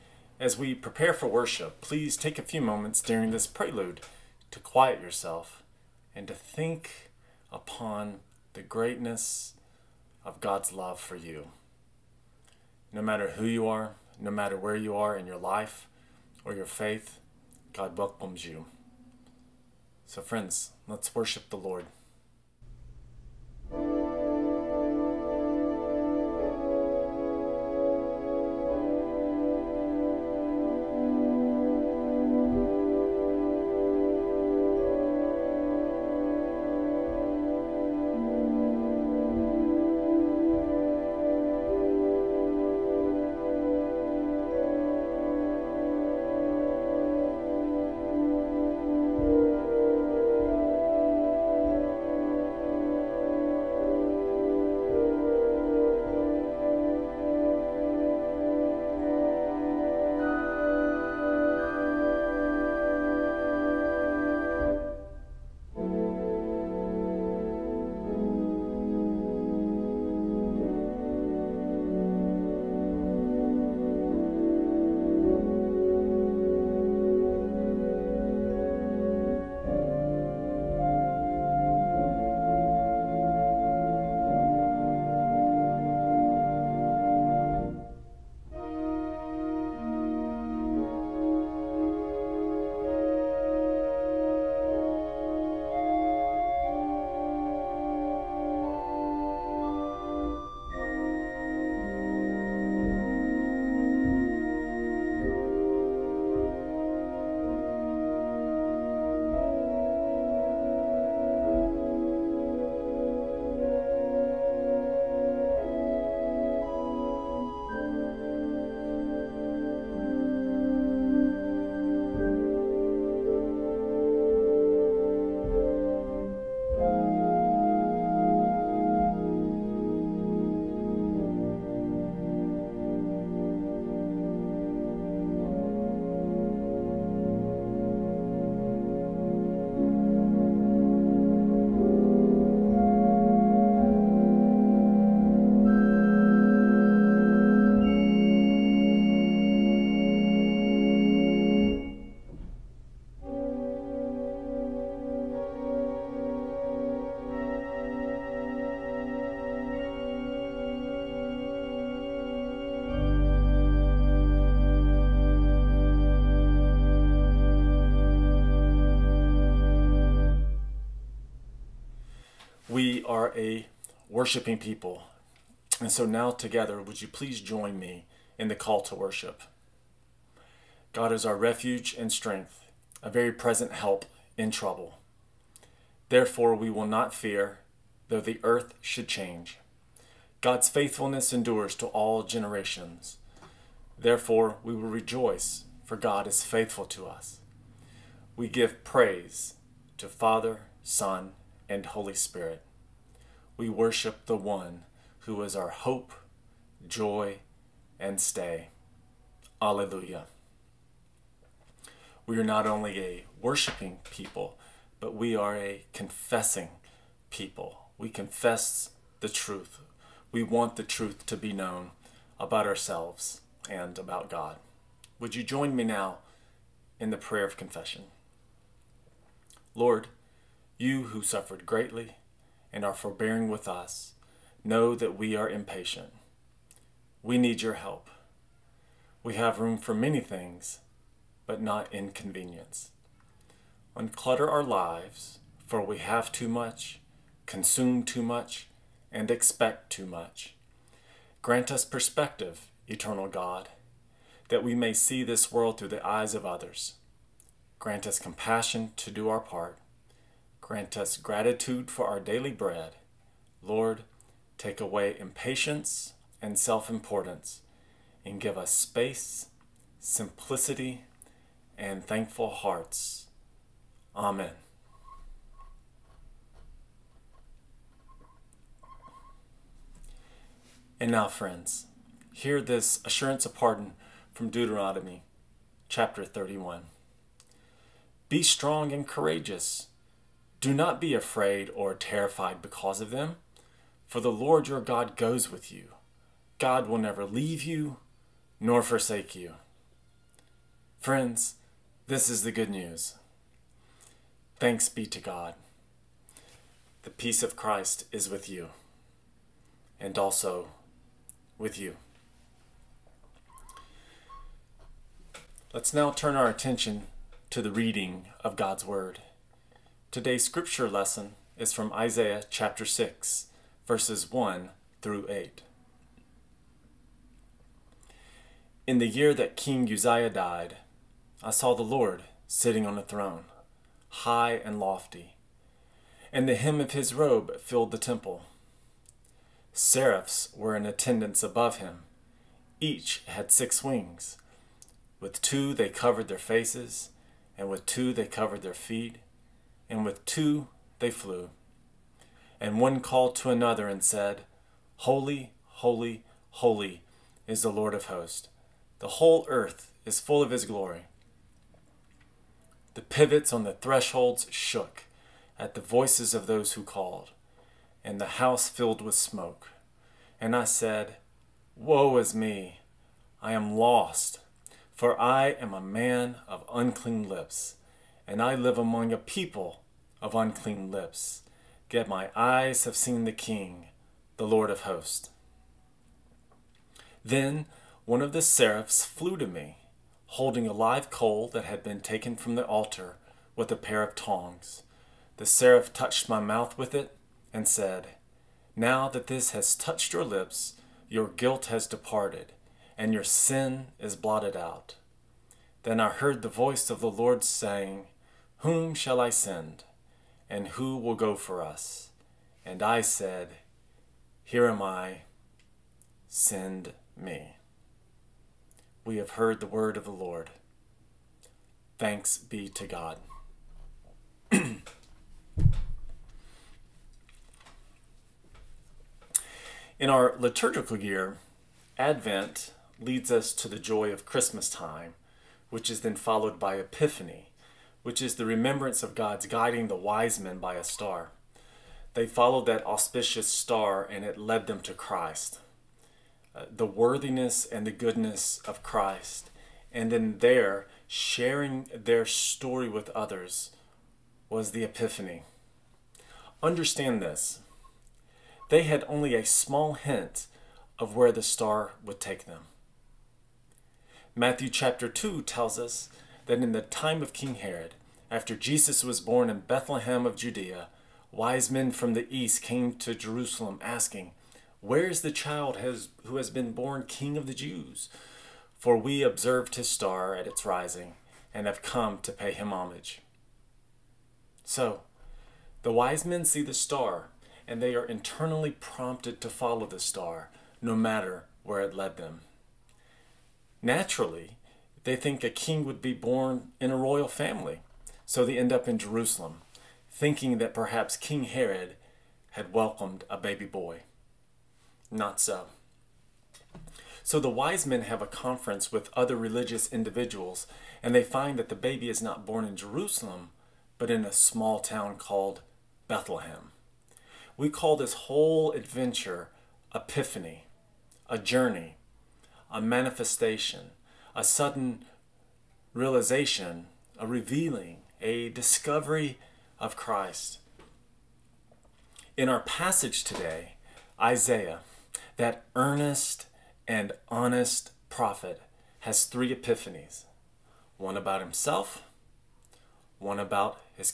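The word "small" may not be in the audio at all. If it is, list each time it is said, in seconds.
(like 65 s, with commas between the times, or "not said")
459 s, 514 s.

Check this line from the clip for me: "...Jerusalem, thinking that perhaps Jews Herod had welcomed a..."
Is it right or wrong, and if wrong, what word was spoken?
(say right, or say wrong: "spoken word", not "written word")
wrong: "King", not "Jews".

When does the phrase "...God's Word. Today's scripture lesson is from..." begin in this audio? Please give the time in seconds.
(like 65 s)
318 s.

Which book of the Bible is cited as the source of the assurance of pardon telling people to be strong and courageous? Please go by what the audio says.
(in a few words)
Deuteronomy.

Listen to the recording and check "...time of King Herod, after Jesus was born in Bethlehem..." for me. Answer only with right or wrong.
right.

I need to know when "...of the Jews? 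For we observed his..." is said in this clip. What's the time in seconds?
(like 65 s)
477 s.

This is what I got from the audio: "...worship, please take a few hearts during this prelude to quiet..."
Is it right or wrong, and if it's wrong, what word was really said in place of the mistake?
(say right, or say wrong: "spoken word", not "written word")
wrong: "moments", not "hearts".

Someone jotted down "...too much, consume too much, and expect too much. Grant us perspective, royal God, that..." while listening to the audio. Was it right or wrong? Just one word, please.
wrong.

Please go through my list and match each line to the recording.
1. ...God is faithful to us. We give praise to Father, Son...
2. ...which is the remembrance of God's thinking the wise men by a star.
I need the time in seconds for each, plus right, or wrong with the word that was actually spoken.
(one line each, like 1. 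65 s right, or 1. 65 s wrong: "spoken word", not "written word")
1. 195 s right
2. 438 s wrong: "guiding", not "thinking".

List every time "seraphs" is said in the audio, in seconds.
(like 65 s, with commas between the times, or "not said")
339 s, 388 s, 395 s.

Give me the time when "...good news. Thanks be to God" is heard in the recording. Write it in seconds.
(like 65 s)
302 s.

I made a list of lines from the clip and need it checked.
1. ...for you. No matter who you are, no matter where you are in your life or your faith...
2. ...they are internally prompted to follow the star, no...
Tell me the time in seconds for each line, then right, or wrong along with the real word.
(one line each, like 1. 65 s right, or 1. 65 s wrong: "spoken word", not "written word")
1. 11 s right
2. 487 s right.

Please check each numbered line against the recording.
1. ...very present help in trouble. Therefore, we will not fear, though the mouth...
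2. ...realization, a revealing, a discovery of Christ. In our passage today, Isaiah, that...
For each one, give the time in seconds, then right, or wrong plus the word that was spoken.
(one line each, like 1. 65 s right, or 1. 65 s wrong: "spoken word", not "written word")
1. 183 s wrong: "earth", not "mouth"
2. 525 s right.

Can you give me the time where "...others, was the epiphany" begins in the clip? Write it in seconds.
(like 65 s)
453 s.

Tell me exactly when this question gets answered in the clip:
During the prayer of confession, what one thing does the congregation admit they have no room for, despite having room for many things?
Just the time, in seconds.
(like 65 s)
241 s.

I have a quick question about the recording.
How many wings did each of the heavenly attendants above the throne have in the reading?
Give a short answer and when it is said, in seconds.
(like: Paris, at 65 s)
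6, at 343 s.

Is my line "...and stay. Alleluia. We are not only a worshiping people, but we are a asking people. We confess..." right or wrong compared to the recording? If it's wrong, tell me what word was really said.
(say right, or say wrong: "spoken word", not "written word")
wrong: "confessing", not "asking".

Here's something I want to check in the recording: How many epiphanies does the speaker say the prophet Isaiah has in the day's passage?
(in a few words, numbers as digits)
3.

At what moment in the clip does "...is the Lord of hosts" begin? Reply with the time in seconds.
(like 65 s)
357 s.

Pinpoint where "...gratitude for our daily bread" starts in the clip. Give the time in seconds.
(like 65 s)
261 s.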